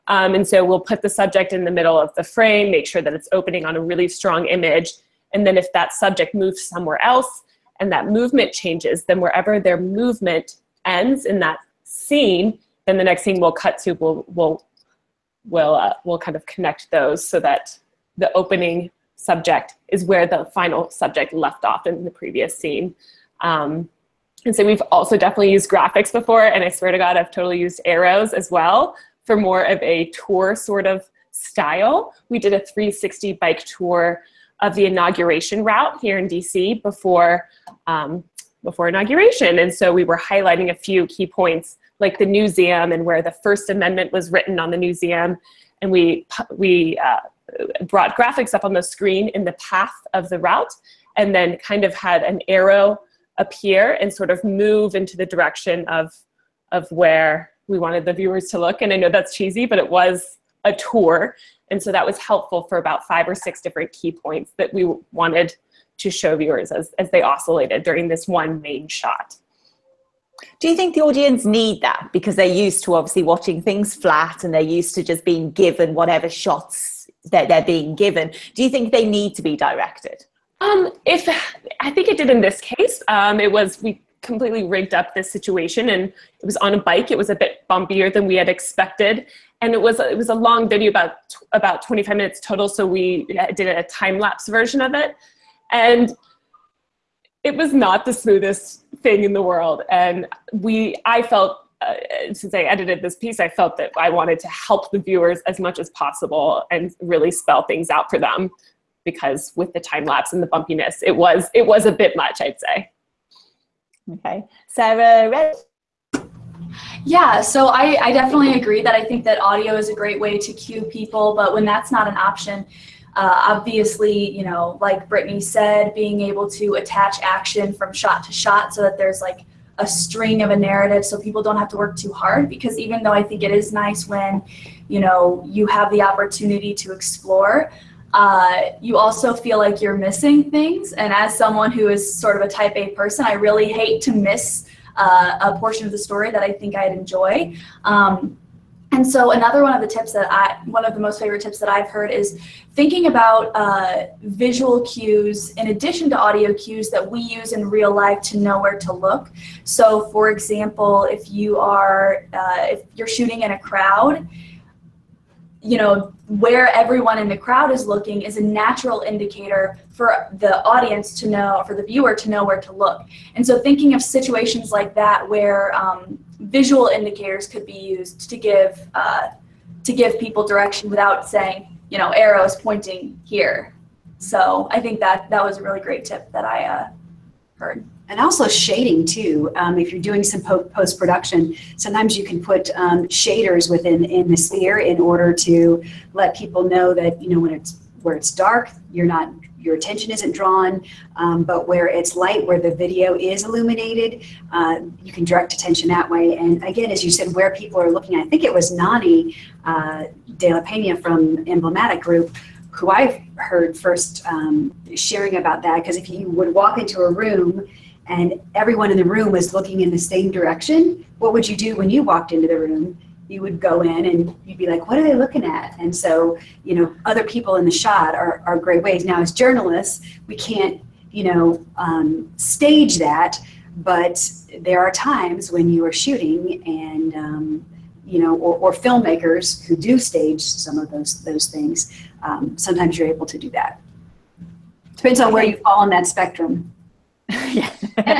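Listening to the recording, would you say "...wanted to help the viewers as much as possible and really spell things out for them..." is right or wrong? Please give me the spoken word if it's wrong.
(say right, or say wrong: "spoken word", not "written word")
right.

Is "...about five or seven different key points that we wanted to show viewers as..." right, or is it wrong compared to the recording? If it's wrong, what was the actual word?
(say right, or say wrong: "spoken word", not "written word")
wrong: "six", not "seven".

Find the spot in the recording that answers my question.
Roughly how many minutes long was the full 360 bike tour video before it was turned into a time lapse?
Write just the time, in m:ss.
1:31.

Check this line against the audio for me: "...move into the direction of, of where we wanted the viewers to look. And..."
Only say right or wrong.
right.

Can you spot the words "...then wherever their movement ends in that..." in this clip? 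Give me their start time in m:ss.
0:09.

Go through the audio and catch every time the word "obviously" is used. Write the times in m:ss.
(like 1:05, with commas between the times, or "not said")
1:12, 2:03.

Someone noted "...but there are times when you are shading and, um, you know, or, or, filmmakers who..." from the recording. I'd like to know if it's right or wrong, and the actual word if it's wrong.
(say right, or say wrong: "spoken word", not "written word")
wrong: "shooting", not "shading".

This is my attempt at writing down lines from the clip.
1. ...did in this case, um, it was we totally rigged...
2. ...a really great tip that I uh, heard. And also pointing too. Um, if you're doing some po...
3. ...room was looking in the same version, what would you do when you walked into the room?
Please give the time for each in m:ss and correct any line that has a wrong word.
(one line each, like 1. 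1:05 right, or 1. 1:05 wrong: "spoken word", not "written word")
1. 1:22 wrong: "completely", not "totally"
2. 3:05 wrong: "shading", not "pointing"
3. 3:39 wrong: "direction", not "version".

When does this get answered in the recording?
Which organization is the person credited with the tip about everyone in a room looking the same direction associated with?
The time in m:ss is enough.
3:31.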